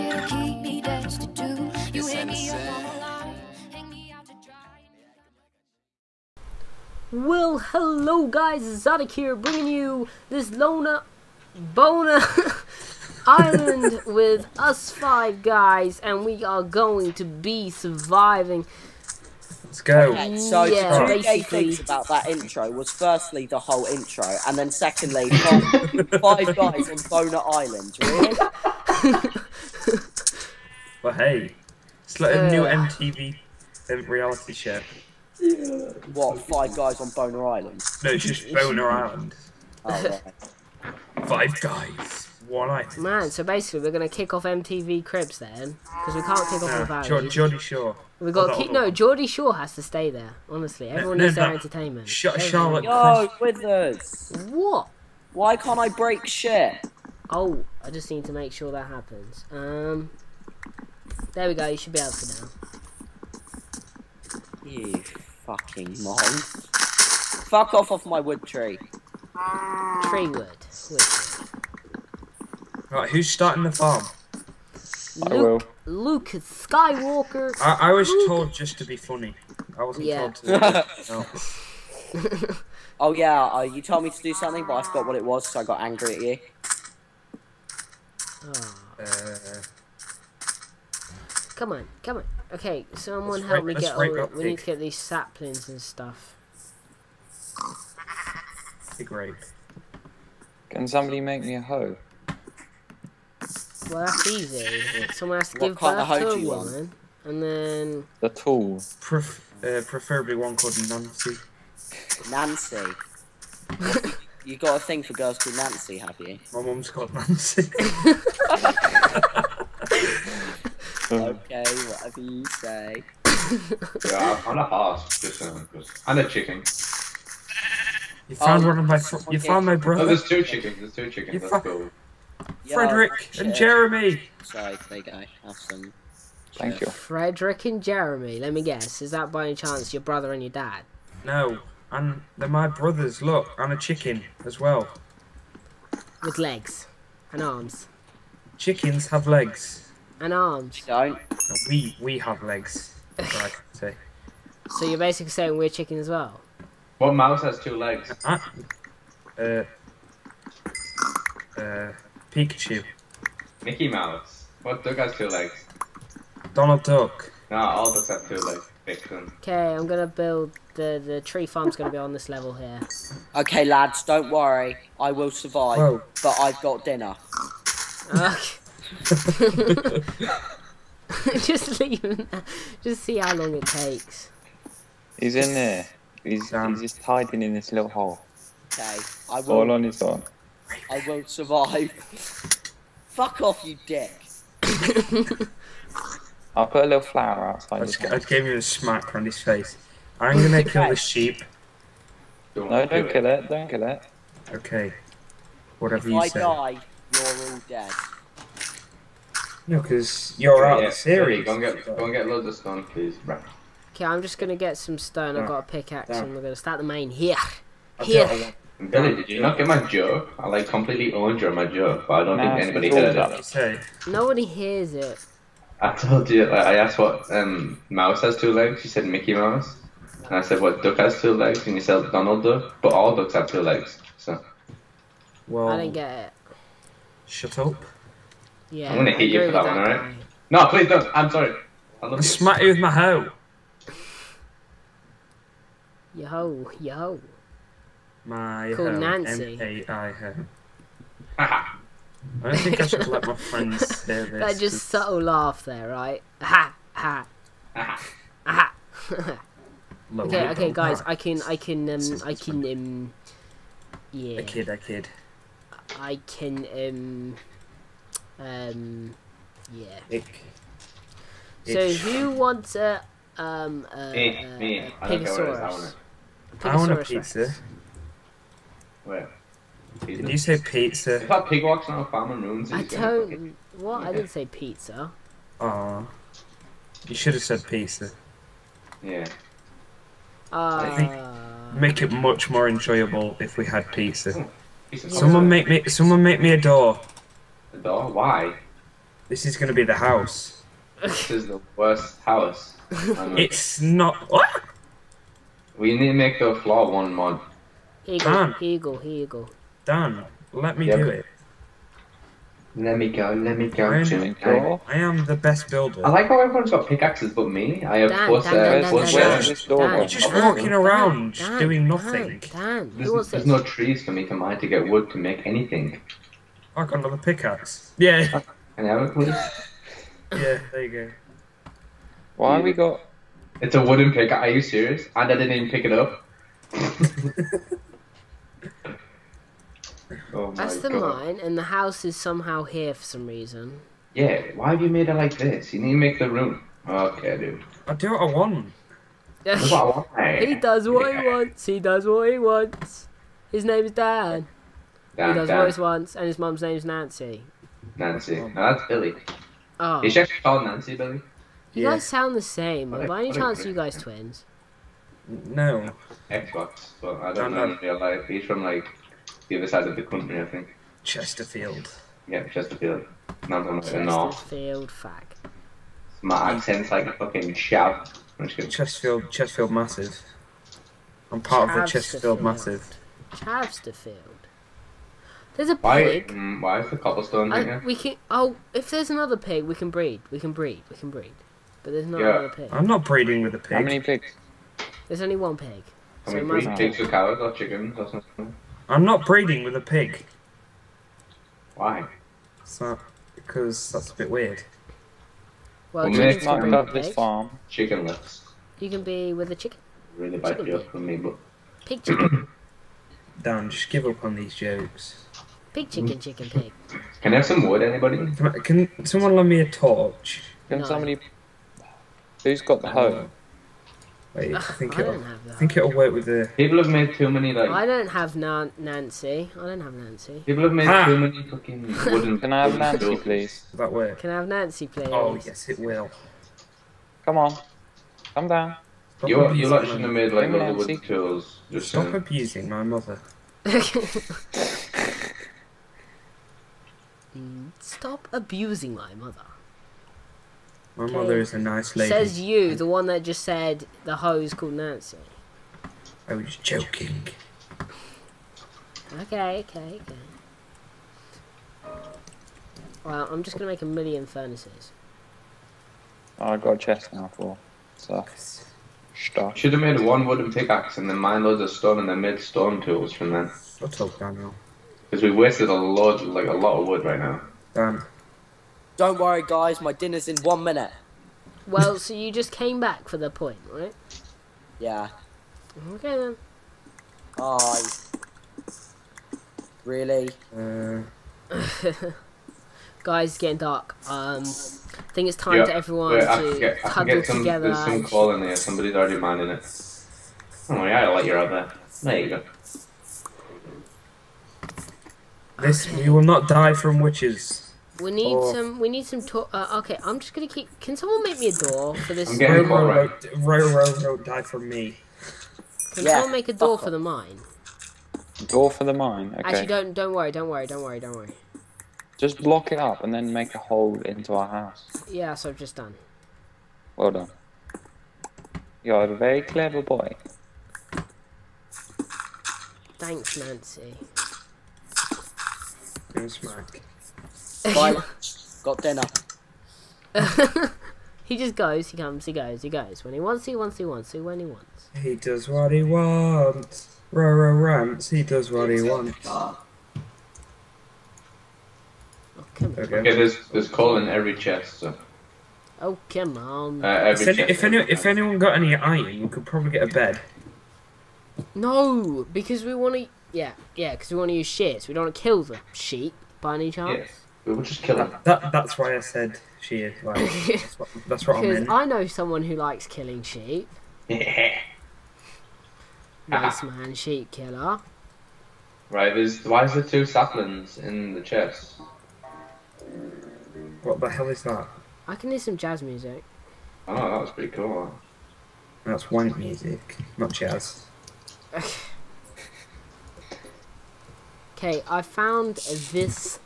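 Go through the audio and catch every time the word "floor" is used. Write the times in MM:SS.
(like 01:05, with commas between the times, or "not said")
05:06.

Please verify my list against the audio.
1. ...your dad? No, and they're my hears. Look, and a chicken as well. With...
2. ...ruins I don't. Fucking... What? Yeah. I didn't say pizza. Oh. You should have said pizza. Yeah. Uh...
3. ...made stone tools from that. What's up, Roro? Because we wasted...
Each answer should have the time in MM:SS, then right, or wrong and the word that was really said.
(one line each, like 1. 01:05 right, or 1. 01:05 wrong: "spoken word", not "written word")
1. 02:20 wrong: "brothers", not "hears"
2. 04:42 right
3. 07:52 wrong: "Daniel", not "Roro".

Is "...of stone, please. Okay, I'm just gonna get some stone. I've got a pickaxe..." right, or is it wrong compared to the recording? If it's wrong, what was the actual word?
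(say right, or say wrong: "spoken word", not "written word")
right.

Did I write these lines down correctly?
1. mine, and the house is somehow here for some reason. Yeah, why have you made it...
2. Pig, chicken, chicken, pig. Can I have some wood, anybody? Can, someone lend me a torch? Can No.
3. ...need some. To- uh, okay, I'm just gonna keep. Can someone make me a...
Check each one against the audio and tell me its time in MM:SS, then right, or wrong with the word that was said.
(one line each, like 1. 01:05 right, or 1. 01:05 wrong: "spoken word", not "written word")
1. 05:41 right
2. 06:55 right
3. 08:28 right.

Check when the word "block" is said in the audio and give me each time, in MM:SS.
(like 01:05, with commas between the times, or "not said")
08:42.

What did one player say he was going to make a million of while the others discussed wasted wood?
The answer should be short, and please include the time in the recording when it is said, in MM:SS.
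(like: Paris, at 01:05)
furnaces, at 07:43.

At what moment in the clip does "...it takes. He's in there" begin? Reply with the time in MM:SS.
03:03.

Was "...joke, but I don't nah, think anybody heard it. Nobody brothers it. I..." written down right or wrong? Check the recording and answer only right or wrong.
wrong.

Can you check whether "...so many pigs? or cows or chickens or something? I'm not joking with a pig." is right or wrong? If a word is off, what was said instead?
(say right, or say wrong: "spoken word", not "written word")
wrong: "breeding", not "joking".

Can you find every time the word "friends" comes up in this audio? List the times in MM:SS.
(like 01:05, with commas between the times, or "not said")
04:13.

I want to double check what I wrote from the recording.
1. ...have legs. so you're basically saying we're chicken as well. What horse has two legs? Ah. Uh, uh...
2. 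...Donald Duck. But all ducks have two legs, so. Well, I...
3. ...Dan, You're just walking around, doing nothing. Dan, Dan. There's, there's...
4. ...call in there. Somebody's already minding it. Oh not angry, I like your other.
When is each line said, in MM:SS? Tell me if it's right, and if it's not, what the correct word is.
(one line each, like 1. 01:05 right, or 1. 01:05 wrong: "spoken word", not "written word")
1. 02:32 wrong: "mouse", not "horse"
2. 03:52 right
3. 05:18 right
4. 08:18 wrong: "worry", not "angry".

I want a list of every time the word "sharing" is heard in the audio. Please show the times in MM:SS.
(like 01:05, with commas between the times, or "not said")
not said.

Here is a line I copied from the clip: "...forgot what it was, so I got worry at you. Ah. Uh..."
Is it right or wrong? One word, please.
wrong.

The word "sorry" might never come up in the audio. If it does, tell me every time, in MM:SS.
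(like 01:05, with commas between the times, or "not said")
02:14, 04:01.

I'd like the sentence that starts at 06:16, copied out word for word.
My accent's like a fucking shout.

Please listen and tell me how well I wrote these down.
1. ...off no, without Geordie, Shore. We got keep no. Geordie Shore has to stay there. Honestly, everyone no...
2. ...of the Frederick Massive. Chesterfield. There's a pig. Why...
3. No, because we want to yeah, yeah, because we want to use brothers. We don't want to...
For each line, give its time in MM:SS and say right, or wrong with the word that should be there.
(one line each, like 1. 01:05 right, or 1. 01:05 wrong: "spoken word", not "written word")
1. 00:46 right
2. 06:21 wrong: "Chesterfield", not "Frederick"
3. 09:21 wrong: "shears", not "brothers".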